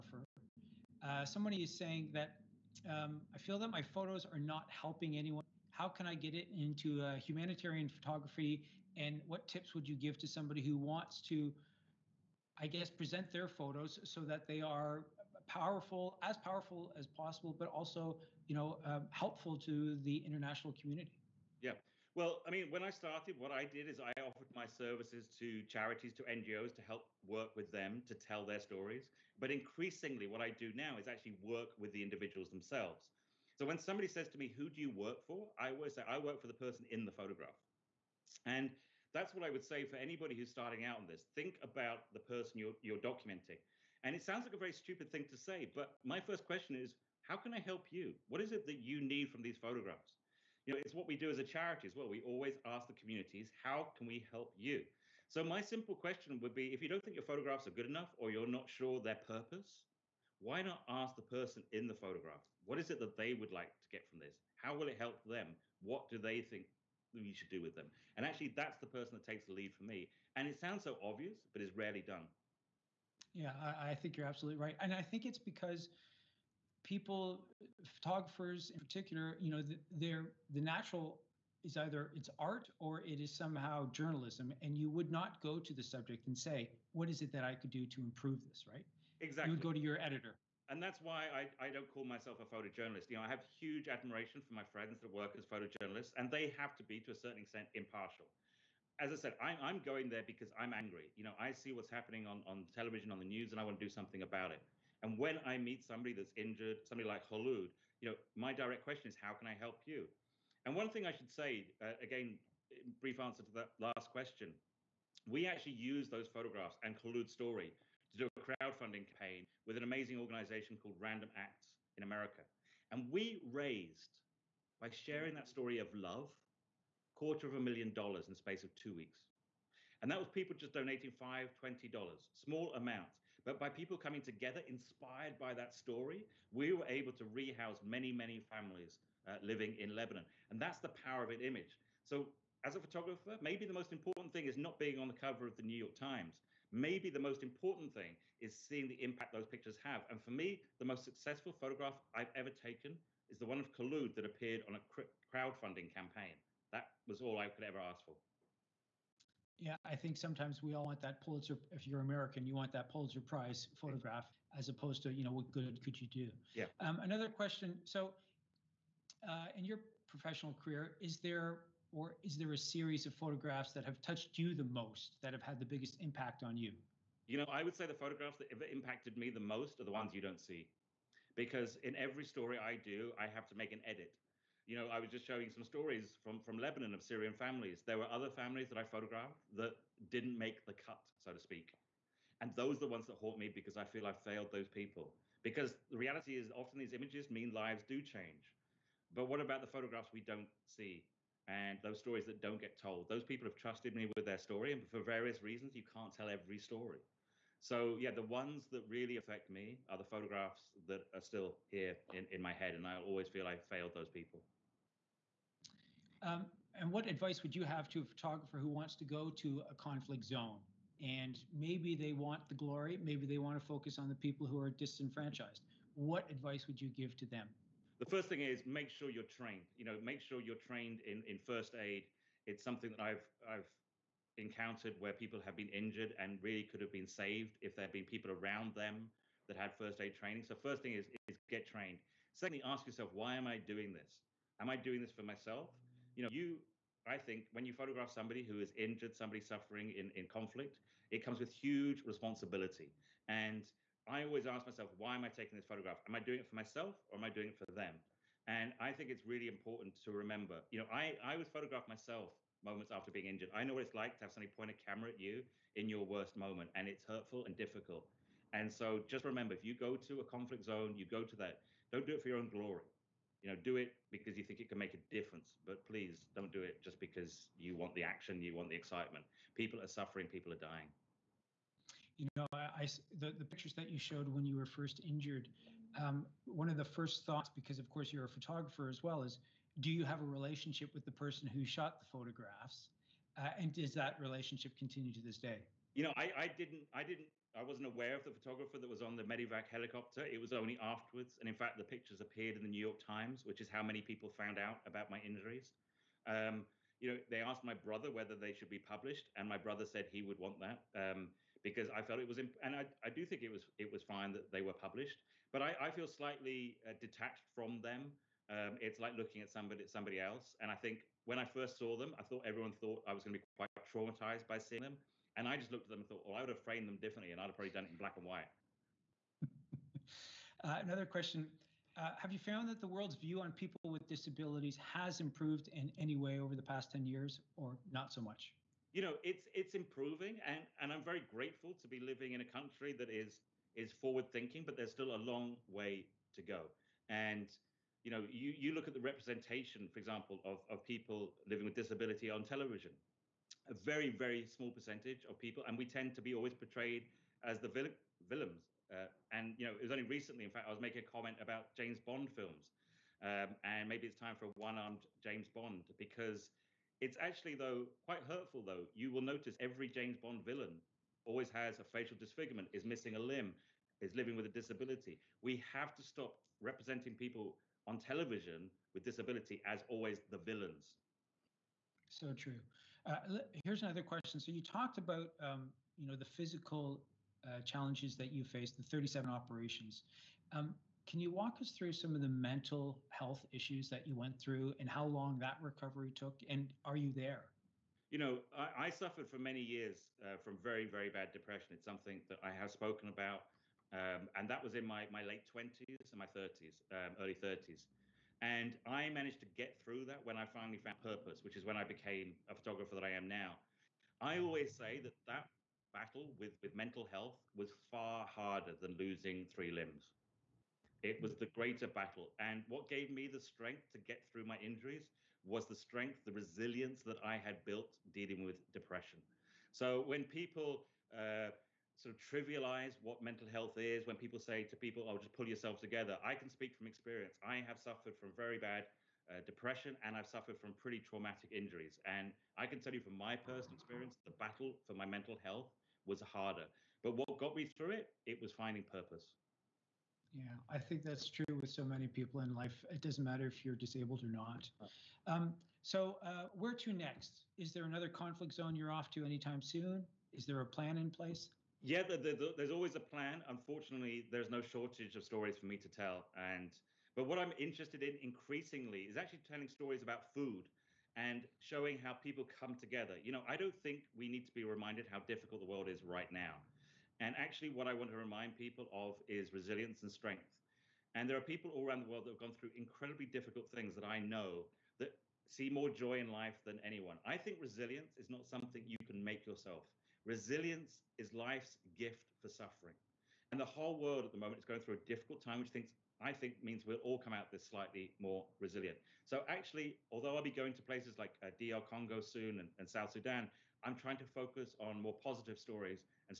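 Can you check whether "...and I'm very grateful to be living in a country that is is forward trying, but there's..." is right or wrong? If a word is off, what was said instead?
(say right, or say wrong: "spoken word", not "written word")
wrong: "thinking", not "trying".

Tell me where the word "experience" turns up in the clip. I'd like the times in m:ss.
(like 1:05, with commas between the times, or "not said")
7:16, 7:23.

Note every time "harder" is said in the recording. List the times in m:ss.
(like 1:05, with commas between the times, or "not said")
6:58, 7:26.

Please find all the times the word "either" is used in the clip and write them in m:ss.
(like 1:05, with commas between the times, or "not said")
1:21.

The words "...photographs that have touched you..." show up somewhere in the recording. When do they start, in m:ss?
2:53.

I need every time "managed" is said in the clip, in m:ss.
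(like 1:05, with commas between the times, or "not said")
6:49.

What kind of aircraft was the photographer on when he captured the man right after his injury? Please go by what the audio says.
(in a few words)
Medivac helicopter.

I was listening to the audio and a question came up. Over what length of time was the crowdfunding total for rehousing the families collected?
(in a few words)
2 weeks.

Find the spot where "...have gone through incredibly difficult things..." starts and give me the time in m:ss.
8:02.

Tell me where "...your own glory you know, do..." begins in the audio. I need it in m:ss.
4:32.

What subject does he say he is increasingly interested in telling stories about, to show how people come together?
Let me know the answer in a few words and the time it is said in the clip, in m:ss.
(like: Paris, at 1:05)
Food, at 7:50.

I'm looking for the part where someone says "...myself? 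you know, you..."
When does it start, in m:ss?
4:05.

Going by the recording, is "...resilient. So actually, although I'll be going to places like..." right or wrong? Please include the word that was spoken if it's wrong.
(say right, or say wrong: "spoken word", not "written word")
right.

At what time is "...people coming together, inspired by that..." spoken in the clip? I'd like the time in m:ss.
2:13.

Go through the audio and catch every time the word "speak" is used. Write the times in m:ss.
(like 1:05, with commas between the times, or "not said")
3:11, 7:16.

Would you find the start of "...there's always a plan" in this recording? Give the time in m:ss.
7:42.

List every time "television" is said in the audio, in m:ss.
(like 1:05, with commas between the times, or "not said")
1:42, 5:52, 6:17.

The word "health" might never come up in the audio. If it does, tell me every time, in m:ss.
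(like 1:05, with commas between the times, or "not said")
6:33, 6:57, 7:13, 7:25.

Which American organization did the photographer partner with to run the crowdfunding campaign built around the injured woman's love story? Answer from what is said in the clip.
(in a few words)
Random Acts.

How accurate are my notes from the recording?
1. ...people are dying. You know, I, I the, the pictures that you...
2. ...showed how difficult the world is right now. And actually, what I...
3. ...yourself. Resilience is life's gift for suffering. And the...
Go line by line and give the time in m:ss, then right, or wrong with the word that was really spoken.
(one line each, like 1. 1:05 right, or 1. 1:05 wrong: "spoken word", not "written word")
1. 4:40 right
2. 7:54 wrong: "reminded", not "showed"
3. 8:09 right.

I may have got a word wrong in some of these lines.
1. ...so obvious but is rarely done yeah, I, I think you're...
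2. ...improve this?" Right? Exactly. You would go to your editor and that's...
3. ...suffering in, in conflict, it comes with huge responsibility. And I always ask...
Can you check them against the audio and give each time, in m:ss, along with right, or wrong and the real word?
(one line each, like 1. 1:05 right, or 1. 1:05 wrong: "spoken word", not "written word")
1. 1:10 right
2. 1:28 right
3. 4:09 right.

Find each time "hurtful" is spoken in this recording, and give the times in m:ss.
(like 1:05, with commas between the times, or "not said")
4:27, 6:08.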